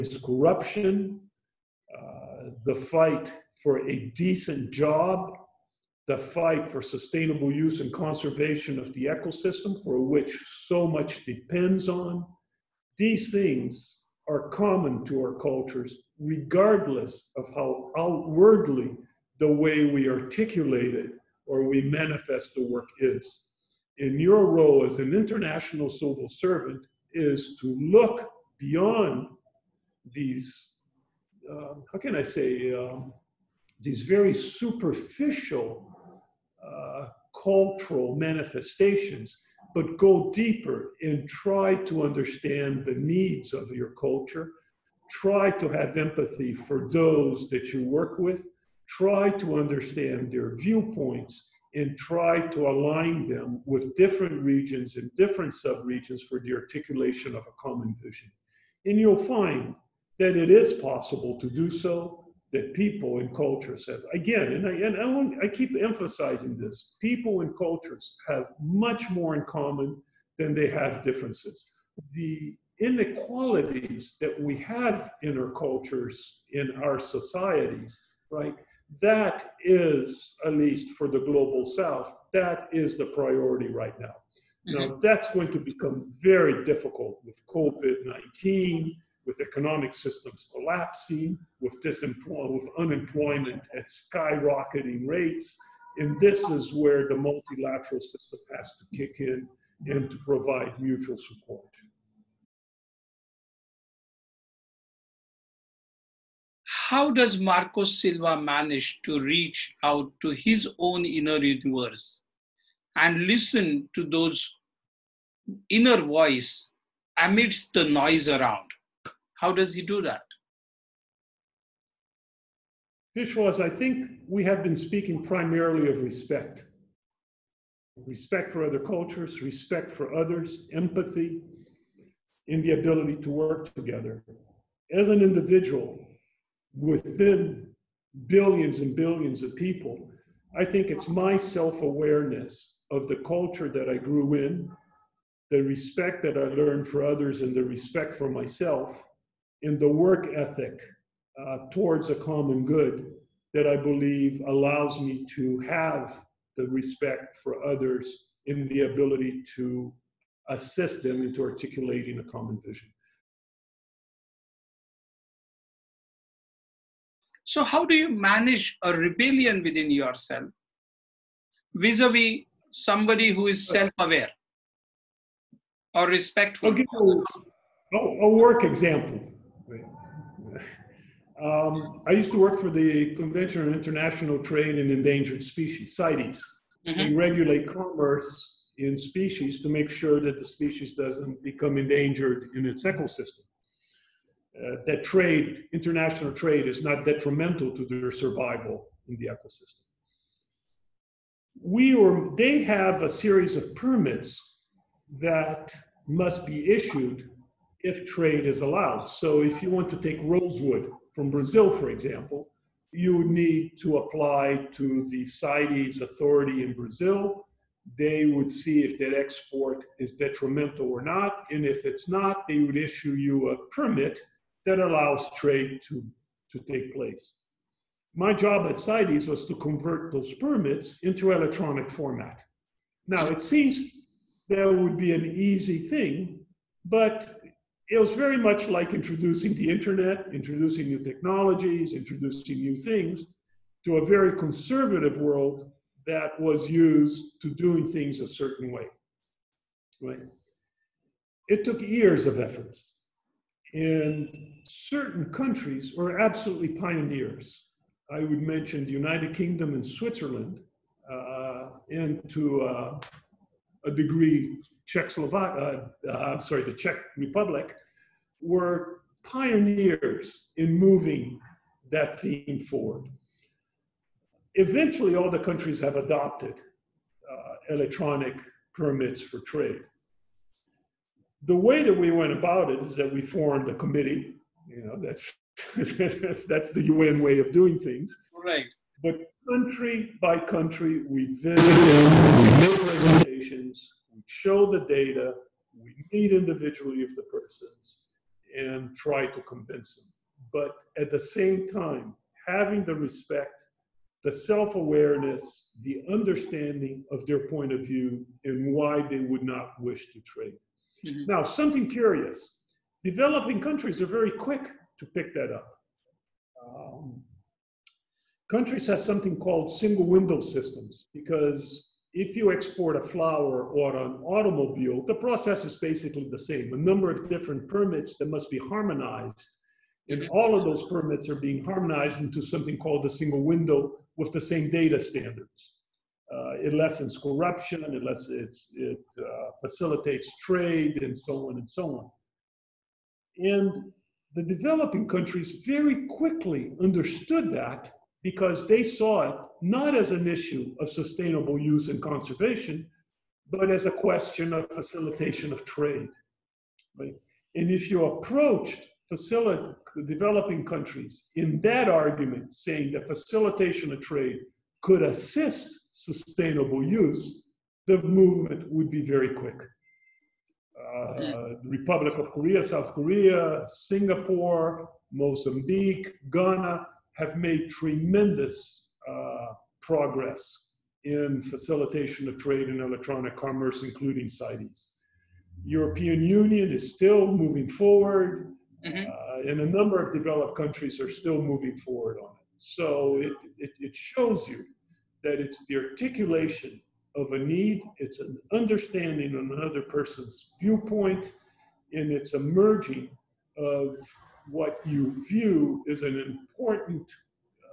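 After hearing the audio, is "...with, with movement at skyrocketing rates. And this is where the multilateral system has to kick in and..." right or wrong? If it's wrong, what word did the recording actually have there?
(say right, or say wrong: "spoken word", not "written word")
wrong: "unemployment", not "movement".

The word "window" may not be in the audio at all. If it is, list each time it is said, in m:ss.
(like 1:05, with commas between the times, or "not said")
5:20, 5:33.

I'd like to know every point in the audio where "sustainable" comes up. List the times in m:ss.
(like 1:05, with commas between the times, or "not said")
0:06, 5:50, 6:05.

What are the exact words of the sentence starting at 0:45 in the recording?
Try to have empathy for those that you work with.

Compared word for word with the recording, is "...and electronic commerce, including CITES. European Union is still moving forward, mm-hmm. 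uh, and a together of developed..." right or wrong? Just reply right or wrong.
wrong.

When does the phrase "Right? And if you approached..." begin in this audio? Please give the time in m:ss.
5:56.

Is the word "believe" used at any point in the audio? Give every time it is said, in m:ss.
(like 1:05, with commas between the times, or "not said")
2:33.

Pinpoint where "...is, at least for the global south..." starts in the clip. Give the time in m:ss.
1:19.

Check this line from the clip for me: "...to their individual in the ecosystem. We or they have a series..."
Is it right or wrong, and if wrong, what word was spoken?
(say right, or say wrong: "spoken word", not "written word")
wrong: "survival", not "individual".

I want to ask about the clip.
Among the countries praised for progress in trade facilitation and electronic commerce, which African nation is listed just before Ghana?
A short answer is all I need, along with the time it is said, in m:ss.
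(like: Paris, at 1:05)
Mozambique, at 6:15.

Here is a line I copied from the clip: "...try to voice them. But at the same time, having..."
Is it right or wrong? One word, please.
wrong.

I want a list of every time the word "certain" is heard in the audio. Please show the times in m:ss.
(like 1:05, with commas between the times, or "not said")
4:08, 4:14.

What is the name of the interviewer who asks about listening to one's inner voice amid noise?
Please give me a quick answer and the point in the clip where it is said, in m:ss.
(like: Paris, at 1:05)
Marcos Silva, at 1:47.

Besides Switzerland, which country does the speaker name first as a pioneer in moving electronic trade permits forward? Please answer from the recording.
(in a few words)
United Kingdom.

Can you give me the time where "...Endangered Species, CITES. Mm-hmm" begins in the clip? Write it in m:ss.
3:04.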